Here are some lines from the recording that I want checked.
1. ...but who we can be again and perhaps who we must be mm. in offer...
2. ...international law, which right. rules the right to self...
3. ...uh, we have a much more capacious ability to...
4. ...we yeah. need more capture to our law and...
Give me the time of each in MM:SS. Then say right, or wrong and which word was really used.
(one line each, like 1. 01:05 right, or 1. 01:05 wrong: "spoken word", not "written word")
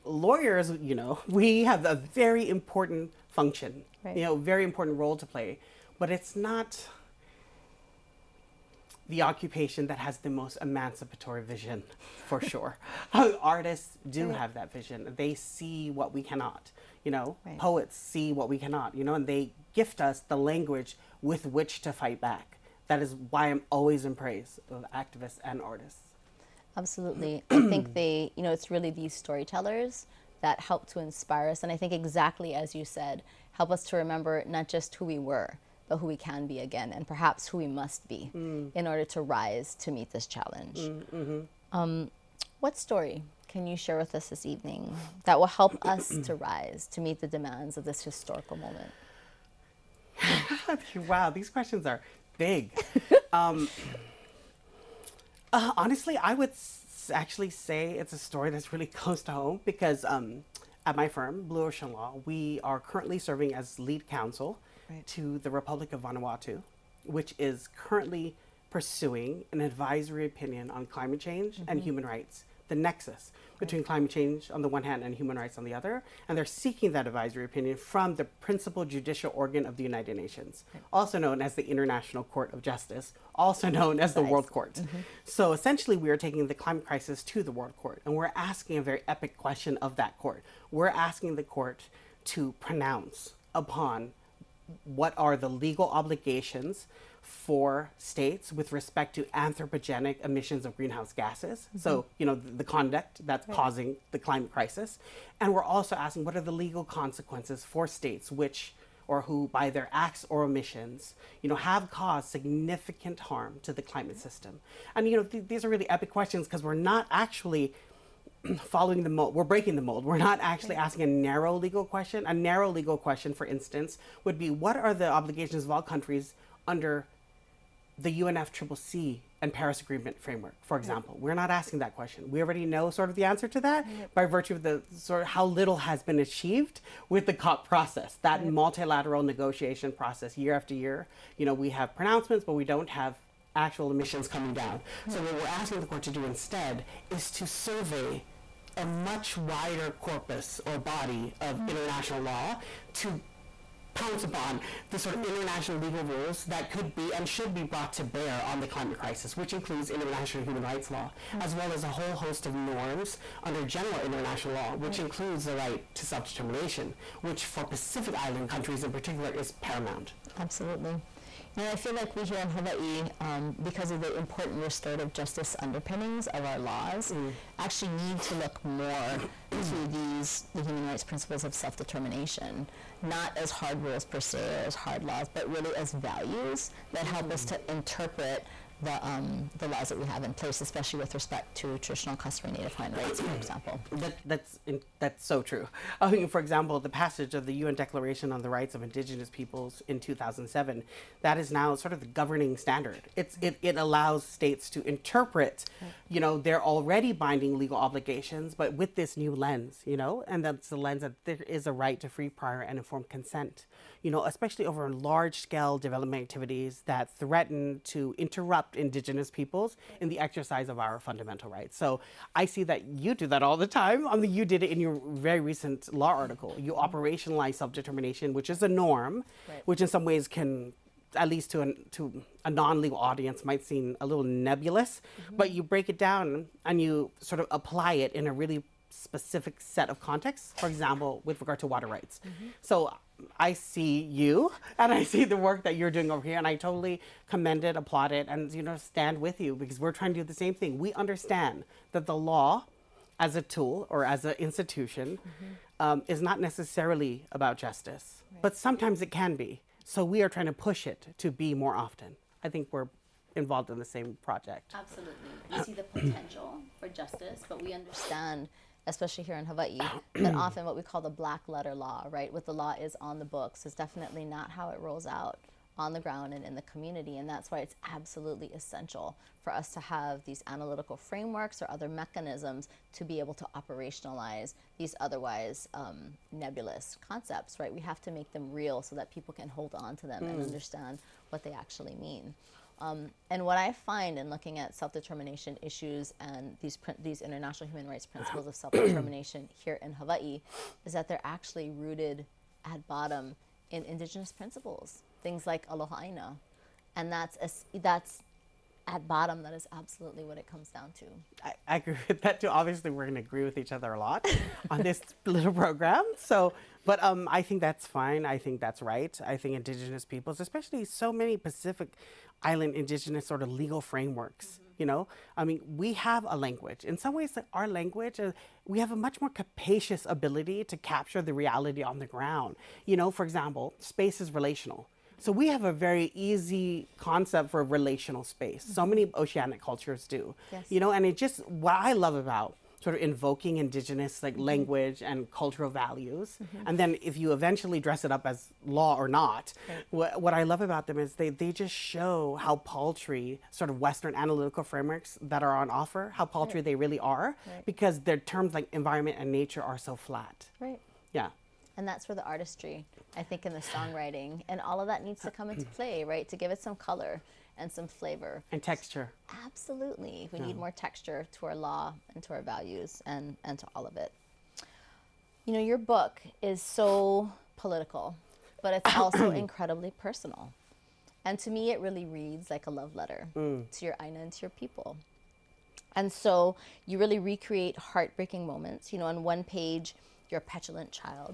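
1. 00:35 wrong: "order", not "offer"
2. 02:43 wrong: "includes", not "rules"
3. 05:28 right
4. 06:10 wrong: "texture", not "capture".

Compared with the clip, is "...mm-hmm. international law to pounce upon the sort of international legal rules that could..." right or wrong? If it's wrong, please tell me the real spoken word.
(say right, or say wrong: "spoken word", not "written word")
right.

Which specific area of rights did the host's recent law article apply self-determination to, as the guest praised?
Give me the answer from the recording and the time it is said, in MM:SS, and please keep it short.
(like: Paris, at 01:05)
water rights, at 04:01.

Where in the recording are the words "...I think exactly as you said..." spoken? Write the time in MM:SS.
00:31.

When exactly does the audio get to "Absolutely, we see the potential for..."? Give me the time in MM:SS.
04:24.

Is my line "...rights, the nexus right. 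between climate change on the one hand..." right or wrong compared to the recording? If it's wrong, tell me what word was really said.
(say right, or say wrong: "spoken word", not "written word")
right.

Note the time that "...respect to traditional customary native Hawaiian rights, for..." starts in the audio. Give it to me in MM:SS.
03:11.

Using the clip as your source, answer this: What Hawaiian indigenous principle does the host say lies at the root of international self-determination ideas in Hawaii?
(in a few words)
aloha aina.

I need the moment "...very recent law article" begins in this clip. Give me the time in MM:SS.
03:45.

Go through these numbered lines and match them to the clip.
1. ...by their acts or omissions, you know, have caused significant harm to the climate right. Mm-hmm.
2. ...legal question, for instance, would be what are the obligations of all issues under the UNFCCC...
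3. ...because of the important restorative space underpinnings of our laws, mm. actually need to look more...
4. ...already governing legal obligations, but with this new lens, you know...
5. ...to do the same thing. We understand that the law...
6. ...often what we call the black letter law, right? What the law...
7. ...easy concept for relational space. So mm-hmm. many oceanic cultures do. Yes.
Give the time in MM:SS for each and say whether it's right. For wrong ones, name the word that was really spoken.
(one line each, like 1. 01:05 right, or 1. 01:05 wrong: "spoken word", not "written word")
1. 01:49 right
2. 02:02 wrong: "countries", not "issues"
3. 02:53 wrong: "justice", not "space"
4. 03:26 wrong: "binding", not "governing"
5. 04:10 right
6. 04:30 right
7. 05:36 right.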